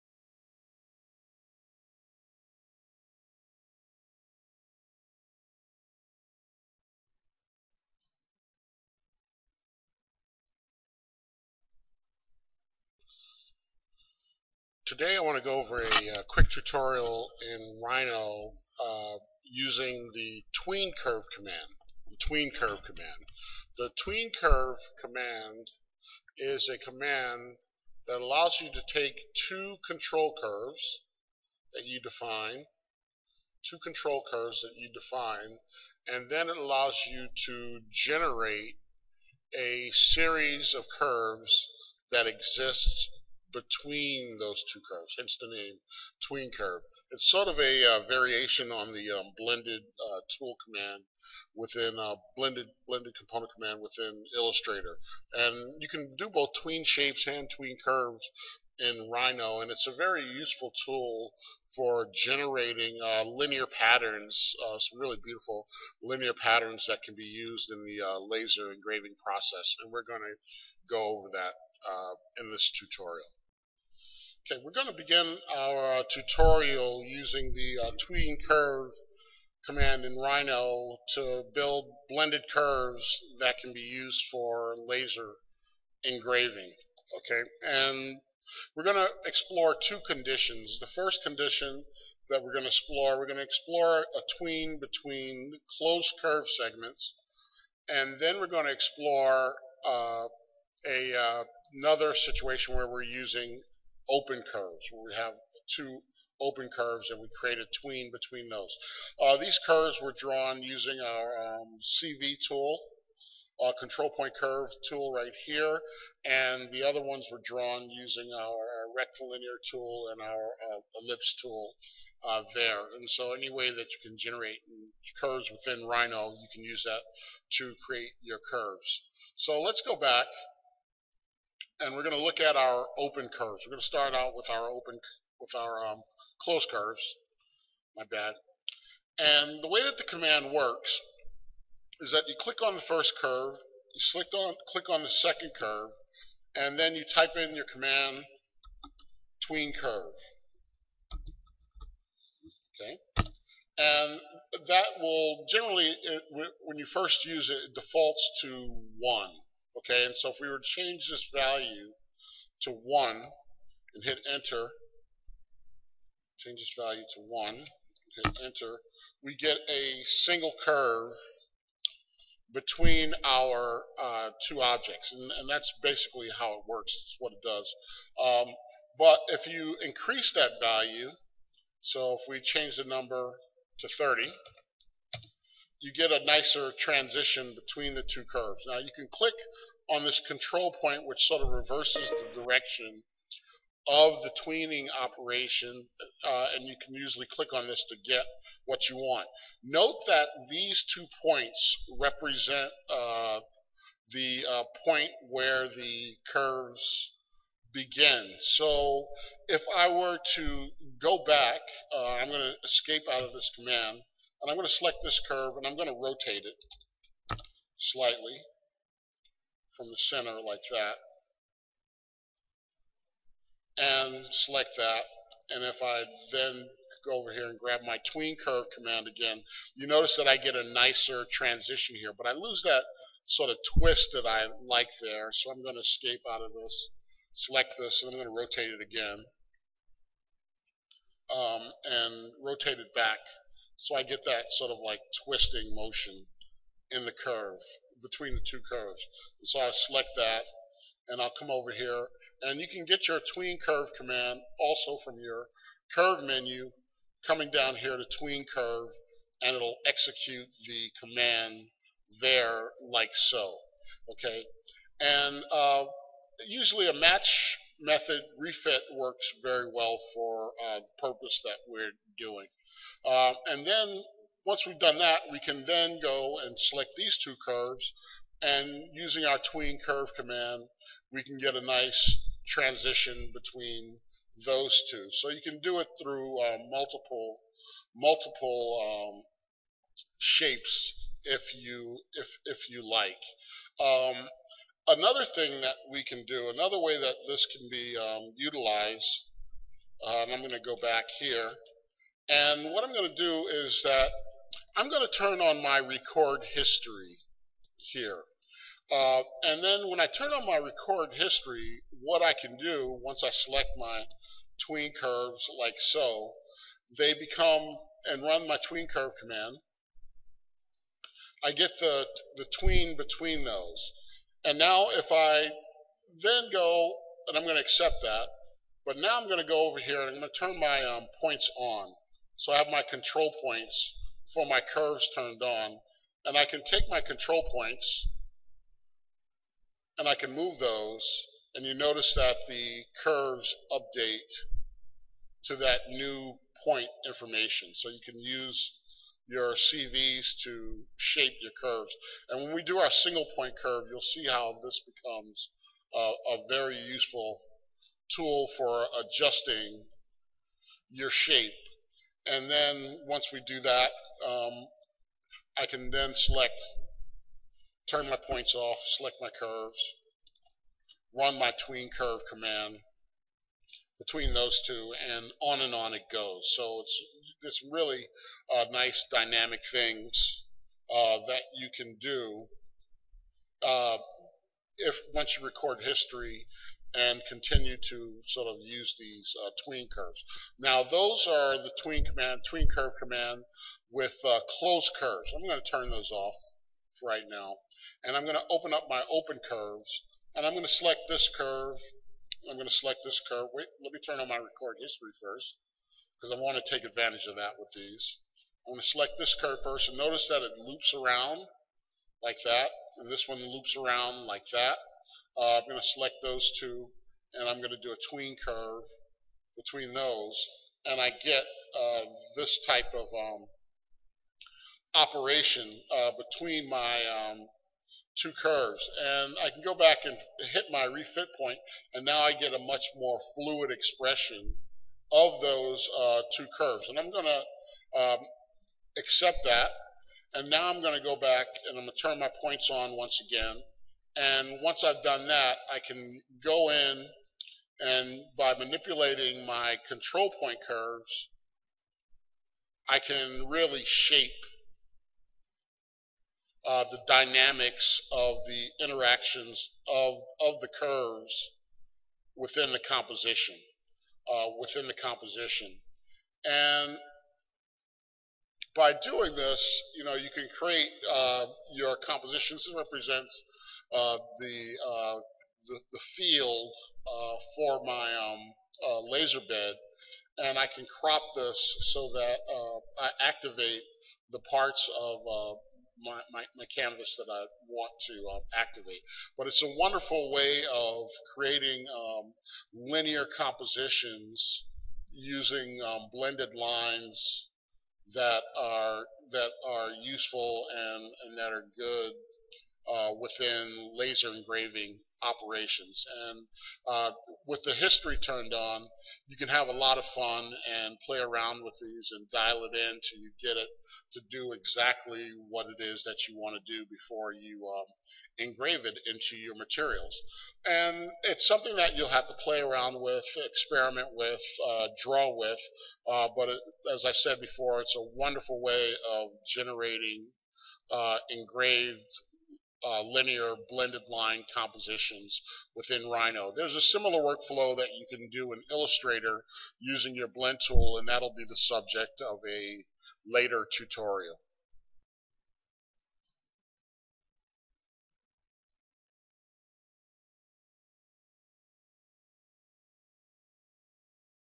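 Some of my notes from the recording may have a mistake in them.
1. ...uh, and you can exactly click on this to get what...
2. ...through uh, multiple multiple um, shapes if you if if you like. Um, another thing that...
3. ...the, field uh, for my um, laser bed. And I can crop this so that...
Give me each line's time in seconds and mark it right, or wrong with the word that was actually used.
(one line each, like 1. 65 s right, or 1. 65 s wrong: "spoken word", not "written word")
1. 196 s wrong: "usually", not "exactly"
2. 286 s right
3. 475 s right.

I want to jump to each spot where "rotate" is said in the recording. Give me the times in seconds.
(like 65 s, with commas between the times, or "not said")
215 s, 238 s, 242 s.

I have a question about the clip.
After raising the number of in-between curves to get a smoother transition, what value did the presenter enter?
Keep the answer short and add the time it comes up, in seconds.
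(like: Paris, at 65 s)
30, at 183 s.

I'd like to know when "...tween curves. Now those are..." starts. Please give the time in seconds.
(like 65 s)
389 s.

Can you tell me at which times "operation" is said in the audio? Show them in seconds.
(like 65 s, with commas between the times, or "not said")
195 s, 424 s, 505 s.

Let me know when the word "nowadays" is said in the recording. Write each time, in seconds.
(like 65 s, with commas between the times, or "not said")
not said.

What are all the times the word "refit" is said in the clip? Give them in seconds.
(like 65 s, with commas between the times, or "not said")
268 s, 430 s.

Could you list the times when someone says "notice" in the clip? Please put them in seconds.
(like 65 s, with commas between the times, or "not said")
229 s, 341 s, 409 s.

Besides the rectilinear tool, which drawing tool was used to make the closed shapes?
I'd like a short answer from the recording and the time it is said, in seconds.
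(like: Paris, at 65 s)
ellipse tool, at 121 s.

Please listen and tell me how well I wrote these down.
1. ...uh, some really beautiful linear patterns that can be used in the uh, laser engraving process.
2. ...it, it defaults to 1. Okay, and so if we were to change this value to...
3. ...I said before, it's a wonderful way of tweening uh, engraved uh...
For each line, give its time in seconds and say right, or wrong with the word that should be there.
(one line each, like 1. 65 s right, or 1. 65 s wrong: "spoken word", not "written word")
1. 64 s right
2. 157 s right
3. 527 s wrong: "generating", not "tweening".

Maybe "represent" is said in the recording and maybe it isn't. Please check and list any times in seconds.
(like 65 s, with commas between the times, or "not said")
201 s, 472 s.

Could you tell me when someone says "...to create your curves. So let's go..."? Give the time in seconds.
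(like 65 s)
127 s.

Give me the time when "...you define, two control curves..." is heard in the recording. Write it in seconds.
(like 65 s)
31 s.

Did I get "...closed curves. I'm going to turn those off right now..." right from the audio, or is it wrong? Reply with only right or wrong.
right.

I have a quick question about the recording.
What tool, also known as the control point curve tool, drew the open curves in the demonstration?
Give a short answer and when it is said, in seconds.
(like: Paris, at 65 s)
CV tool, at 111 s.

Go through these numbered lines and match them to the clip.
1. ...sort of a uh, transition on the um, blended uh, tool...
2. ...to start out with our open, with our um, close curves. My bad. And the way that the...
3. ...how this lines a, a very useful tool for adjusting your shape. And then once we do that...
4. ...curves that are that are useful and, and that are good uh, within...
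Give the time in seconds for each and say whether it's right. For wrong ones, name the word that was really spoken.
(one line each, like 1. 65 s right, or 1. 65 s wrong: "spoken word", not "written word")
1. 47 s wrong: "variation", not "transition"
2. 133 s right
3. 354 s wrong: "becomes", not "lines"
4. 496 s wrong: "lines", not "curves".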